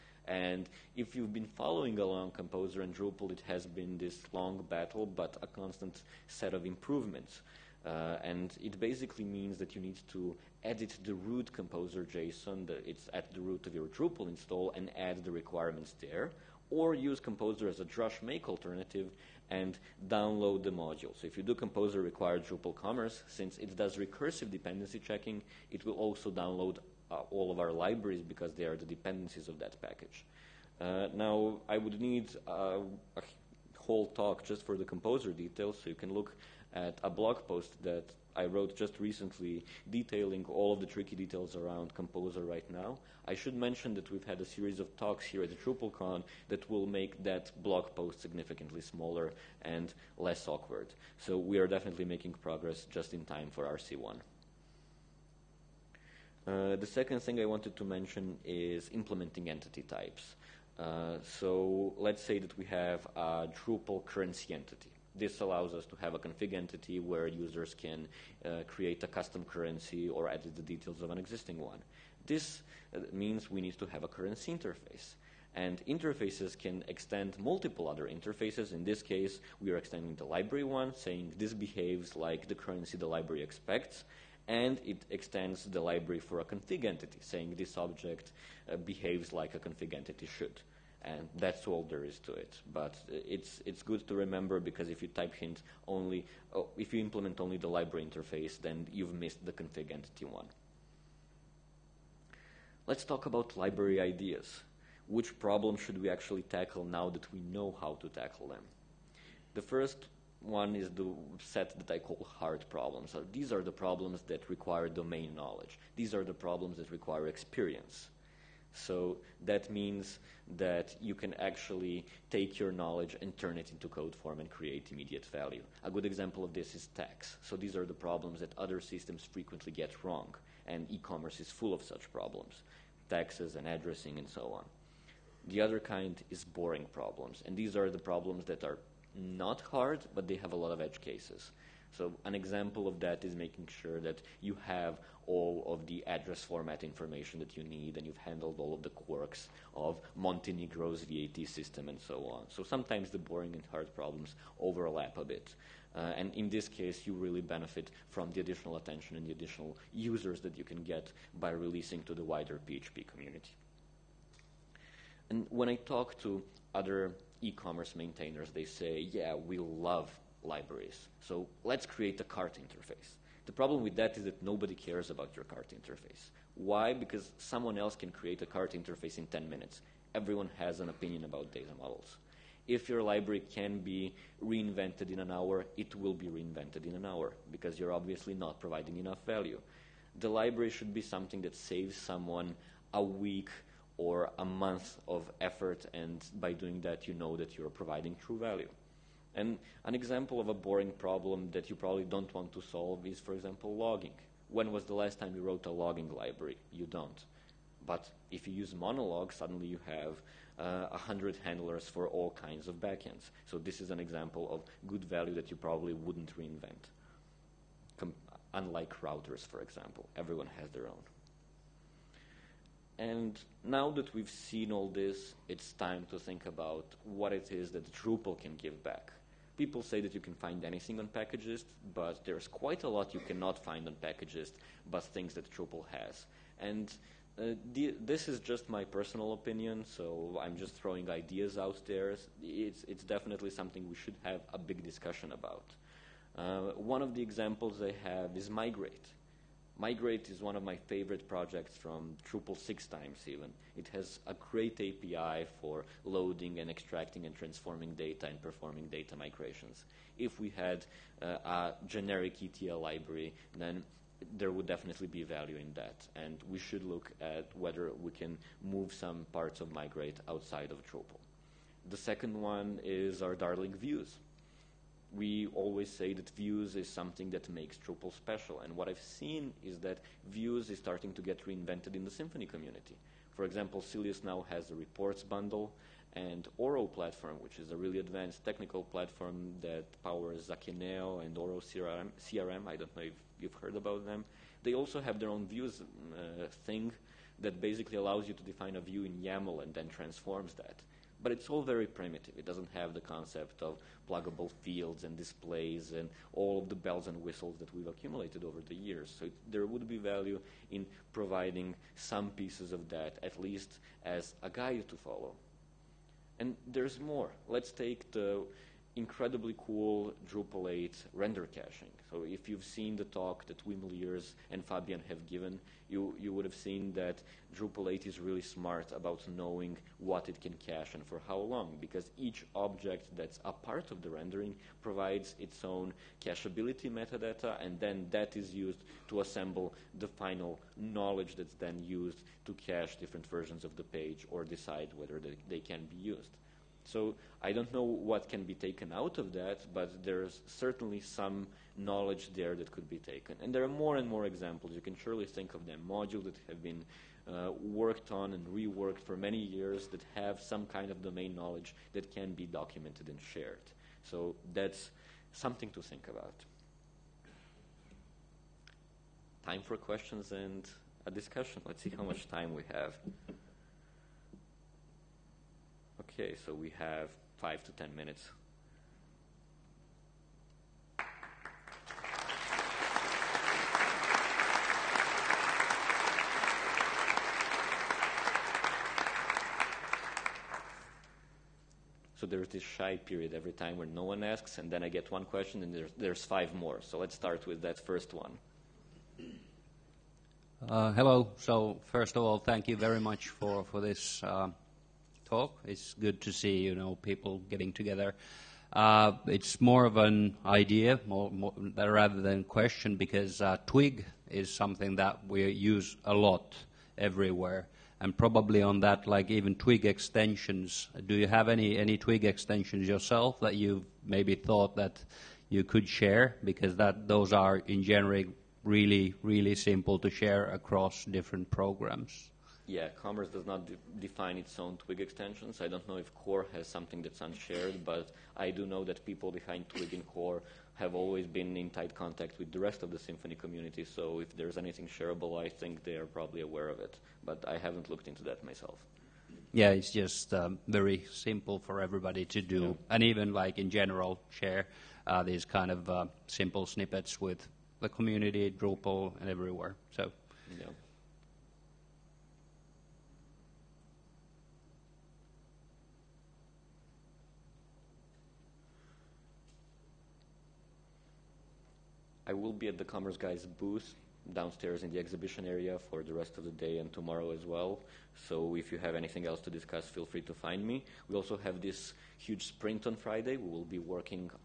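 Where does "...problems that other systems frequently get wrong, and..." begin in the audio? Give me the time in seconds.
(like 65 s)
127 s.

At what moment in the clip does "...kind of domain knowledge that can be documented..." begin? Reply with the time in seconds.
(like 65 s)
360 s.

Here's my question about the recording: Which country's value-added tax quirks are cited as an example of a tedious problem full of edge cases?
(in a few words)
Montenegro.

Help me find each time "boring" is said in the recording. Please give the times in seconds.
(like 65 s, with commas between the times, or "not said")
136 s, 153 s, 200 s.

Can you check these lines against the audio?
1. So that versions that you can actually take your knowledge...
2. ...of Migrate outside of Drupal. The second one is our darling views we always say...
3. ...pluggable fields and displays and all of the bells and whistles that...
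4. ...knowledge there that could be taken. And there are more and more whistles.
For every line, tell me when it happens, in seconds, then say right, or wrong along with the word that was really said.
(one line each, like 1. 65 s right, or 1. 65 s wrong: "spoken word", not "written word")
1. 118 s wrong: "means", not "versions"
2. 269 s right
3. 304 s right
4. 351 s wrong: "examples", not "whistles".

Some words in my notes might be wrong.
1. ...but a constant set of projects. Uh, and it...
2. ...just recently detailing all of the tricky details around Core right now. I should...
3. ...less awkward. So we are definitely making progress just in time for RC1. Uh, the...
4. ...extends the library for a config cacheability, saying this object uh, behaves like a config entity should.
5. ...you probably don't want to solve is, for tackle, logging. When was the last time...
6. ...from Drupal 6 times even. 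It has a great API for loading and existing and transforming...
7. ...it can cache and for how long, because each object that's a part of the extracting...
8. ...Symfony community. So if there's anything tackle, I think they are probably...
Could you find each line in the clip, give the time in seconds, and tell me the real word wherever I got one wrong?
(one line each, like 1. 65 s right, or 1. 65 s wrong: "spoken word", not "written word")
1. 5 s wrong: "improvements", not "projects"
2. 38 s wrong: "Composer", not "Core"
3. 50 s right
4. 85 s wrong: "entity", not "cacheability"
5. 201 s wrong: "example", not "tackle"
6. 251 s wrong: "extracting", not "existing"
7. 330 s wrong: "rendering", not "extracting"
8. 442 s wrong: "shareable", not "tackle".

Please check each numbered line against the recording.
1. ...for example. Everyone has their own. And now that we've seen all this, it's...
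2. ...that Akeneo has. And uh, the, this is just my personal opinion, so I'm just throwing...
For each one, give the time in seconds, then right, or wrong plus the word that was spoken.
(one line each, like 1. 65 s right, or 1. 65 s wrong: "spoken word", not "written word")
1. 219 s right
2. 235 s wrong: "Drupal", not "Akeneo".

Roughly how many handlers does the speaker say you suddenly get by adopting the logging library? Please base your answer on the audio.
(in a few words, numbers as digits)
100.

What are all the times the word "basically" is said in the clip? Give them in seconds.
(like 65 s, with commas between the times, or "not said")
8 s, 297 s.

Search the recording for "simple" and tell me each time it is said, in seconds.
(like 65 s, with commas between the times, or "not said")
429 s, 451 s, 456 s.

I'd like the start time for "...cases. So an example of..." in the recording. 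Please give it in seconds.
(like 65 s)
141 s.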